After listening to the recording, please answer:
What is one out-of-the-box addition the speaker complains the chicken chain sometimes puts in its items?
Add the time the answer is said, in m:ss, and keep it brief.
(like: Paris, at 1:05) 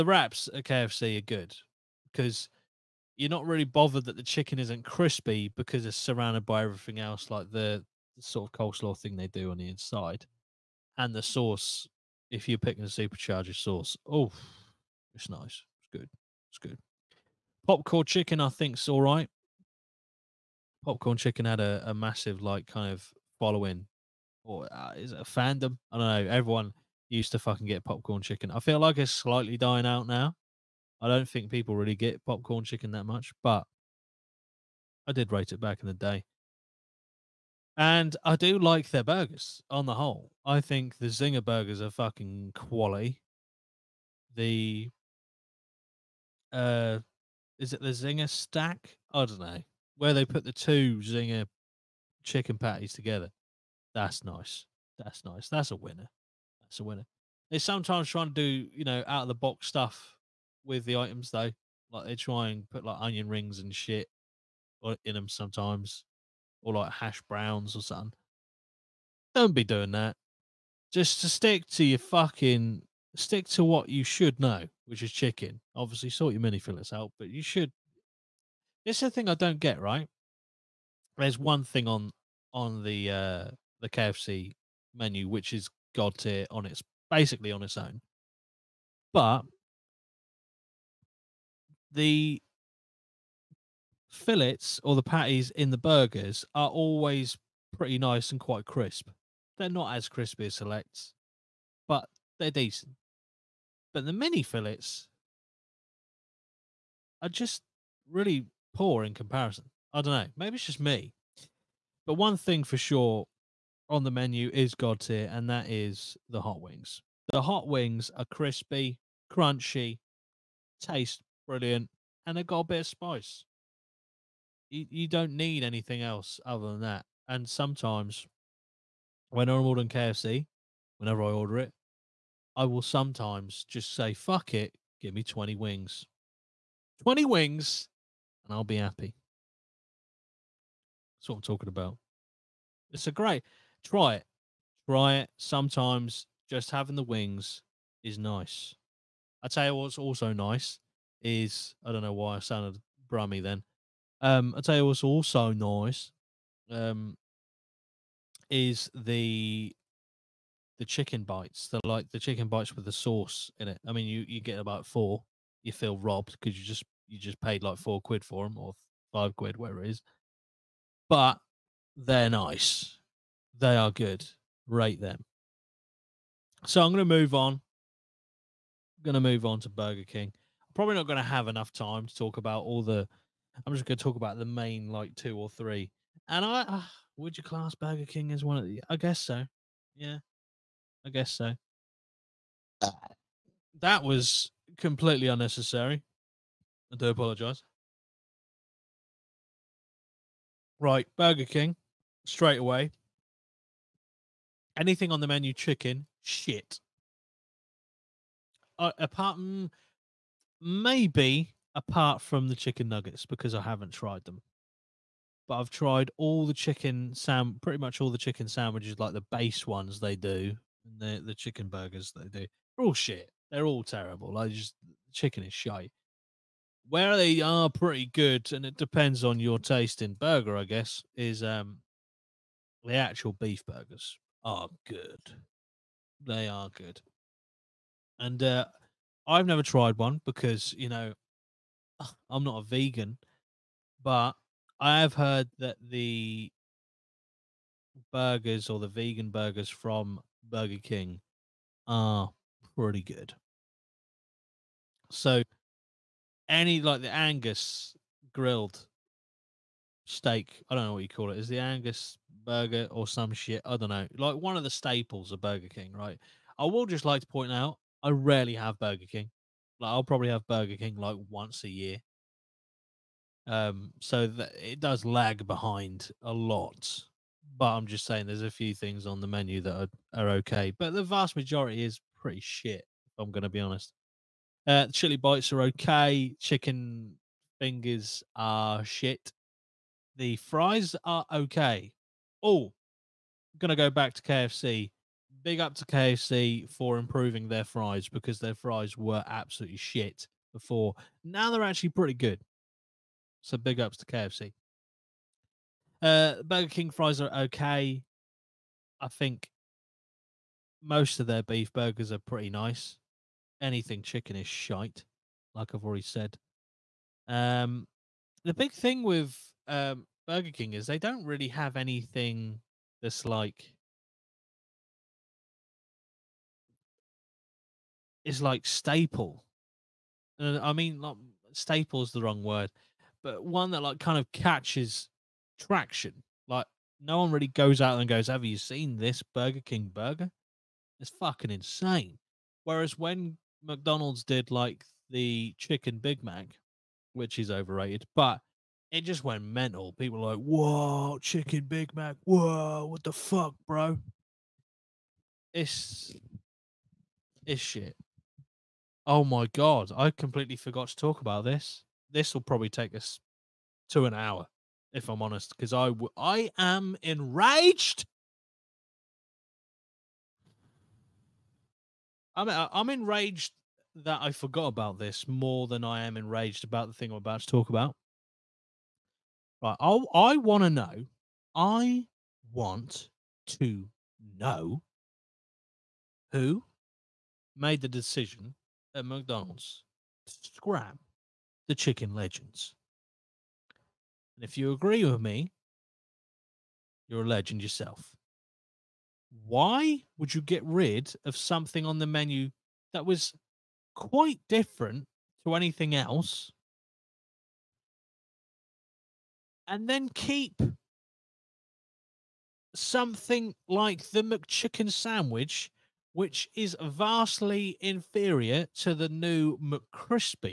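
Onion rings, at 1:03.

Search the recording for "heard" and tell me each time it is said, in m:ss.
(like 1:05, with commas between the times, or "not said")
4:05.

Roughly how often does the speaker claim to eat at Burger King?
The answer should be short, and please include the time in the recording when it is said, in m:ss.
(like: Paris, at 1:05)
Once a year, at 4:31.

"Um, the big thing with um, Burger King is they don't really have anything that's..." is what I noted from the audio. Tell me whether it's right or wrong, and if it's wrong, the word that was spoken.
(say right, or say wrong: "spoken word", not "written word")
right.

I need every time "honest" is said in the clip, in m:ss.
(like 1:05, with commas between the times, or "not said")
4:43, 6:05.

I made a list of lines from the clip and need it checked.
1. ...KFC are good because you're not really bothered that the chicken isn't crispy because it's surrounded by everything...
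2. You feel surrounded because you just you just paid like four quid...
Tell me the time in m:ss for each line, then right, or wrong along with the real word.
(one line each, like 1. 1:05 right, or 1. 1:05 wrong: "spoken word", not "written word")
1. 0:00 right
2. 2:45 wrong: "robbed", not "surrounded".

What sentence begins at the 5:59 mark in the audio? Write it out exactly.
Oh my god, I completely forgot to talk about this.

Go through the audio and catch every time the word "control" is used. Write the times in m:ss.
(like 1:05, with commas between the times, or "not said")
not said.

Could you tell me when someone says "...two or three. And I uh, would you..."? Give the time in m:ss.
3:05.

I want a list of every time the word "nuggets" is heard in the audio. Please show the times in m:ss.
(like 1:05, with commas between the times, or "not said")
3:32.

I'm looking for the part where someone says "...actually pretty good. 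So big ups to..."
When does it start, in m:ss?
5:01.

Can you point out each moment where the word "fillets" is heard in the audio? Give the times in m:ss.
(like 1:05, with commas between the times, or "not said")
1:16, 1:34, 1:44.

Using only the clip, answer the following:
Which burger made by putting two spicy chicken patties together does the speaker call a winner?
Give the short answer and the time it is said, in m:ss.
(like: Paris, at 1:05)
Zinger stack, at 0:47.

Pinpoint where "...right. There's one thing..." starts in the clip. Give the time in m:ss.
1:19.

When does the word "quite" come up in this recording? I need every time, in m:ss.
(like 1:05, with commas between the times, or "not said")
1:38, 6:43.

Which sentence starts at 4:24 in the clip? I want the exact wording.
Like one of the staples of Burger King, right?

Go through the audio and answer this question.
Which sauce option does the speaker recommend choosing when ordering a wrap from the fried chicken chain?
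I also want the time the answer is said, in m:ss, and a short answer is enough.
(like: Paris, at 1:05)
Supercharger, at 0:12.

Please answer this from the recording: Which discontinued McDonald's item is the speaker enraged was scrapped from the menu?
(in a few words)
Chicken legends.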